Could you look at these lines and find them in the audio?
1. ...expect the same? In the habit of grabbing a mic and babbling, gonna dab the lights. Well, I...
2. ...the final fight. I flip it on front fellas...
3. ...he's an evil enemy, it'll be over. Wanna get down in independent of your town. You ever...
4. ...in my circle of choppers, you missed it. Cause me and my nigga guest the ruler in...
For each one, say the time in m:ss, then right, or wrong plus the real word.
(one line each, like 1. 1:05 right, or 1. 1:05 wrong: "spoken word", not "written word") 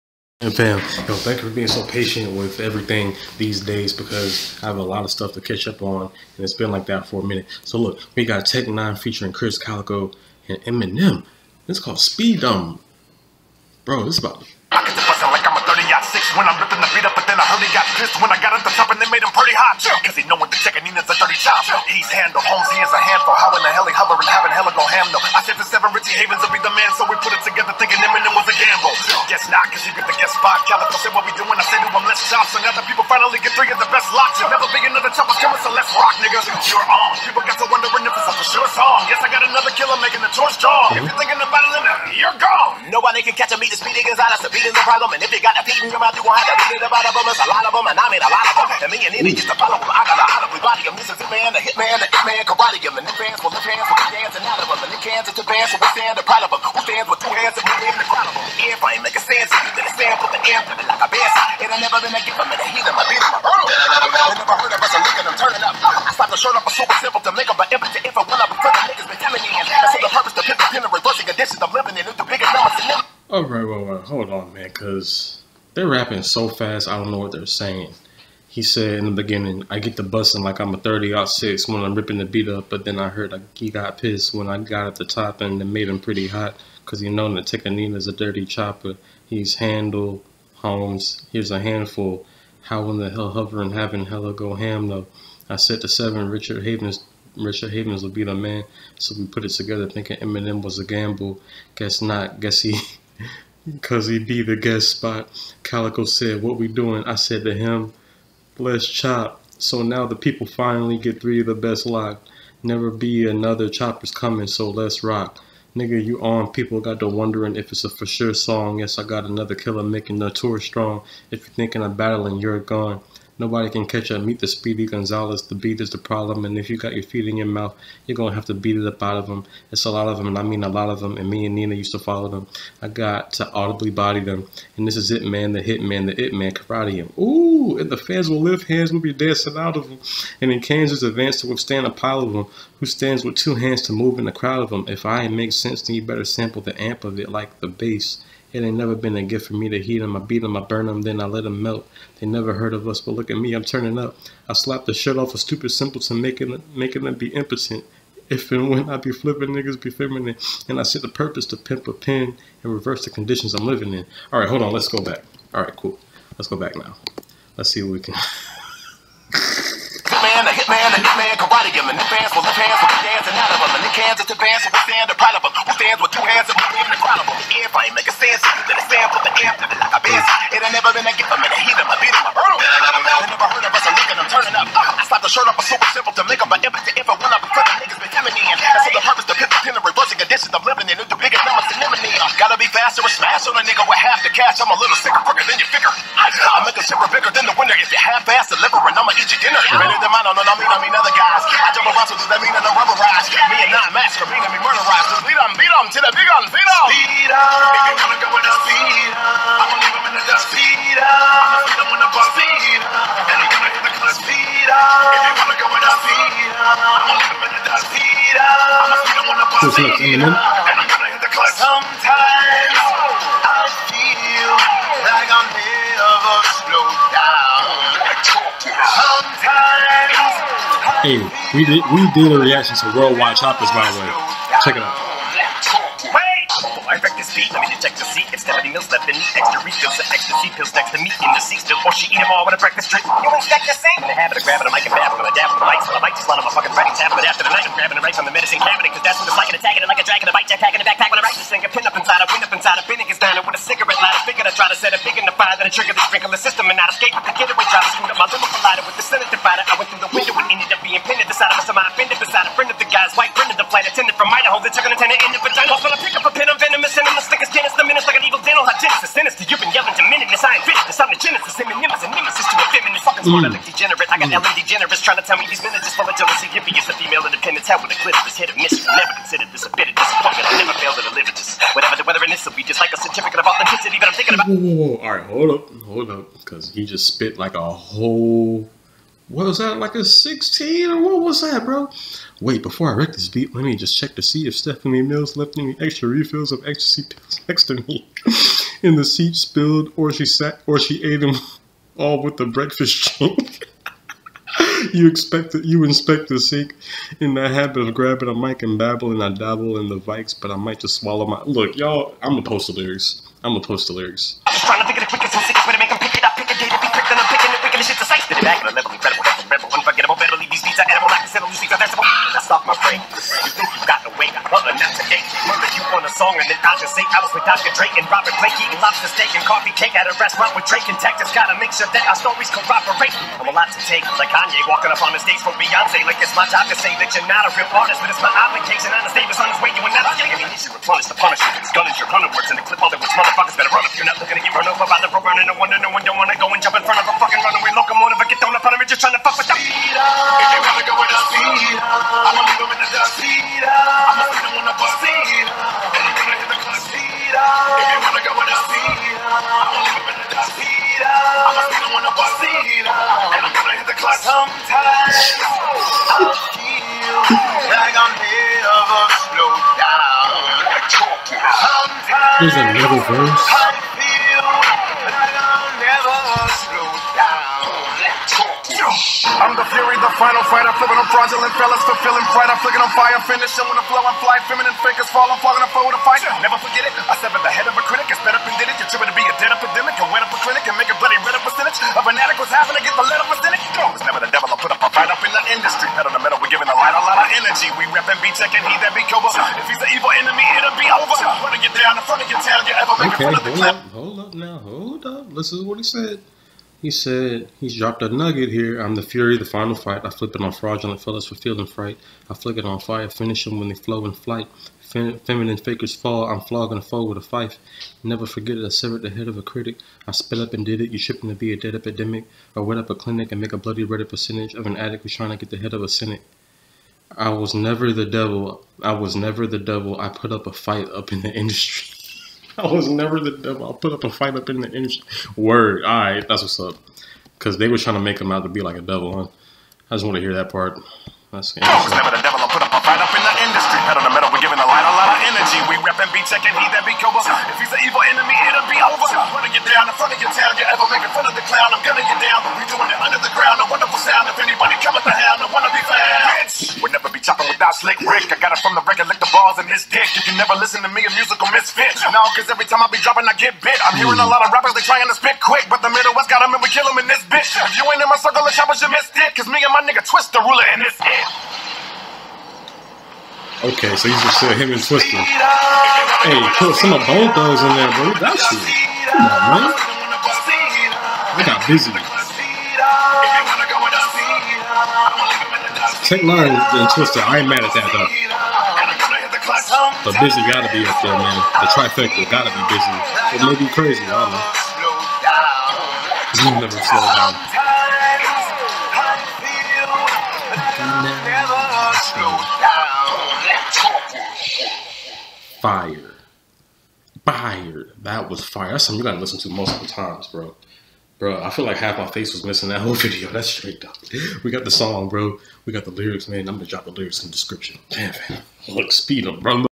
1. 4:03 right
2. 6:49 wrong: "fraudulent", not "front"
3. 7:27 wrong: "front", not "independent"
4. 7:48 wrong: "twist", not "guest".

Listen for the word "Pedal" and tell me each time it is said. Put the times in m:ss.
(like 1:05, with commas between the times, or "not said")
6:35, 7:23.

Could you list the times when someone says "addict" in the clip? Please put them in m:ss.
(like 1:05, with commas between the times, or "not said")
6:32, 7:04.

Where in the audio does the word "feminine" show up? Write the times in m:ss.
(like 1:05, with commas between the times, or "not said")
2:39, 6:24, 6:55.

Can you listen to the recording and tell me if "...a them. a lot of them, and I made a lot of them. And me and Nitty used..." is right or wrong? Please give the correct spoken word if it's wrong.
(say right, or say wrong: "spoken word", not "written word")
right.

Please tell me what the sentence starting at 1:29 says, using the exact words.
He's handled Holmes, here's a handful.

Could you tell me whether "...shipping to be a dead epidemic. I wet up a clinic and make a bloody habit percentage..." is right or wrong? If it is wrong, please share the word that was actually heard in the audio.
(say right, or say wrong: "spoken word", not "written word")
wrong: "reddit", not "habit".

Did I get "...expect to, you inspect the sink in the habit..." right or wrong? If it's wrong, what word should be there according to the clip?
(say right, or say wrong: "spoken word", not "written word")
right.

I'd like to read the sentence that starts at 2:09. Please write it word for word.
It's a lot of them, and I mean a lot of them.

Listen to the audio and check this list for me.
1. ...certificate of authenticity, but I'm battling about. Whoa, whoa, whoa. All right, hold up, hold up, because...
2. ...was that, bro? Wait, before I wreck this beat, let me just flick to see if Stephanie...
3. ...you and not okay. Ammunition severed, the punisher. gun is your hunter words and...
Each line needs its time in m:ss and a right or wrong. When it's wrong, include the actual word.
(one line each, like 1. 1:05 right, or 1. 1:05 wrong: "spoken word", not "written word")
1. 4:42 wrong: "thinking", not "battling"
2. 4:51 wrong: "check", not "flick"
3. 5:39 wrong: "replenished", not "severed".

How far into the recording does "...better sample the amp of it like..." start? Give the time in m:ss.
2:26.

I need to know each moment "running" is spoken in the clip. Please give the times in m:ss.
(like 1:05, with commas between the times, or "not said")
5:45, 6:41.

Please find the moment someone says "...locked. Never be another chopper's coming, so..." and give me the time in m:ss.
1:51.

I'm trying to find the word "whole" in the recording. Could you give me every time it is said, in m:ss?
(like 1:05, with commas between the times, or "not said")
4:47, 8:32.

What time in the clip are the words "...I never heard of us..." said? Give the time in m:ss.
3:02.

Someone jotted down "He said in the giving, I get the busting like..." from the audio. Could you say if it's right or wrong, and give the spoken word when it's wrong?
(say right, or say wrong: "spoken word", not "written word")
wrong: "beginning", not "giving".